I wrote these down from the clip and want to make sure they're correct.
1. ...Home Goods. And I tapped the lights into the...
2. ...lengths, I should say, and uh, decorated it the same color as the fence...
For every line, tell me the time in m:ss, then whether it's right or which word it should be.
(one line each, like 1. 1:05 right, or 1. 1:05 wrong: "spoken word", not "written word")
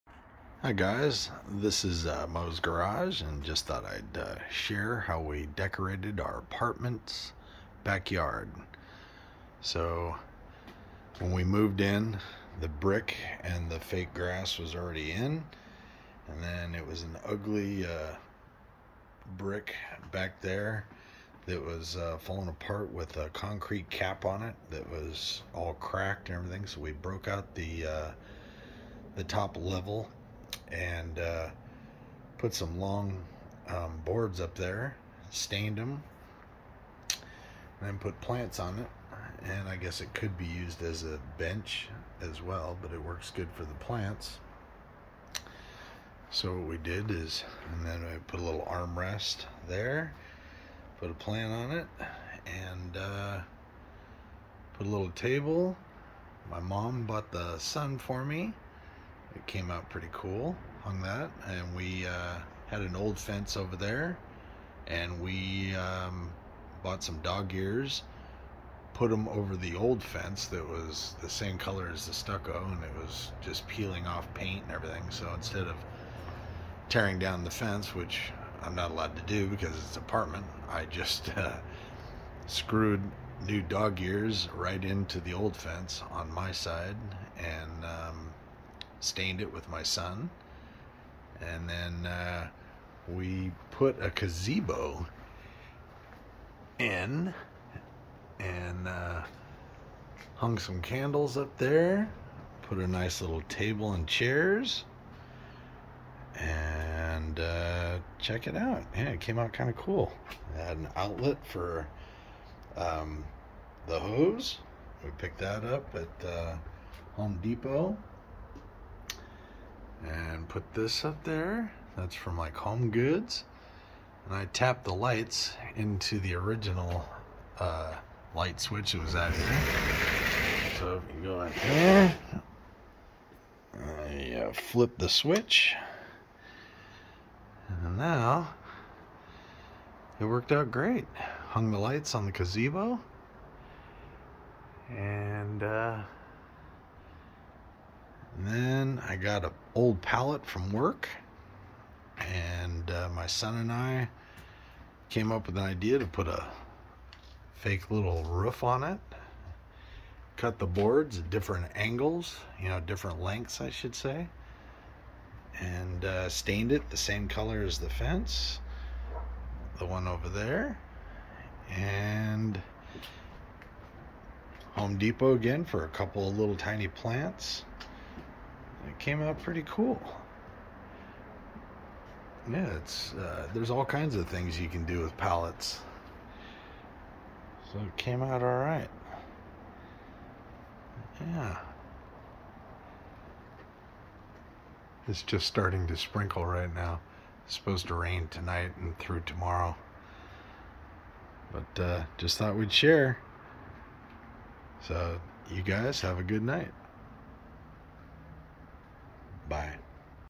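1. 2:02 right
2. 2:43 wrong: "stained", not "decorated".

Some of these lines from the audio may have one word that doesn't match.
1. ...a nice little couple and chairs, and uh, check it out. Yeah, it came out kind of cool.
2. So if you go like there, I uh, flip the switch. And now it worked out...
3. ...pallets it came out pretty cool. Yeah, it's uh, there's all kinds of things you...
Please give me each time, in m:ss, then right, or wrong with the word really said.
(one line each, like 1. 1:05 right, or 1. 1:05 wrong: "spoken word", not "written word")
1. 1:42 wrong: "table", not "couple"
2. 2:10 right
3. 2:56 wrong: "plants", not "pallets".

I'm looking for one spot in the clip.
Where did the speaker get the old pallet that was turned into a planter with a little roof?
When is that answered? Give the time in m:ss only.
2:30.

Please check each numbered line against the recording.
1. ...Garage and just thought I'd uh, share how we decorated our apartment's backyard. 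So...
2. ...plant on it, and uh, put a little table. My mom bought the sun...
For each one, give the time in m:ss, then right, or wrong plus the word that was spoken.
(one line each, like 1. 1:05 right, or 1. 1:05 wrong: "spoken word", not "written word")
1. 0:02 right
2. 0:51 right.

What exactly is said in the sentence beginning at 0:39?
And I guess it could be used as a bench as well, but it works good for the plants.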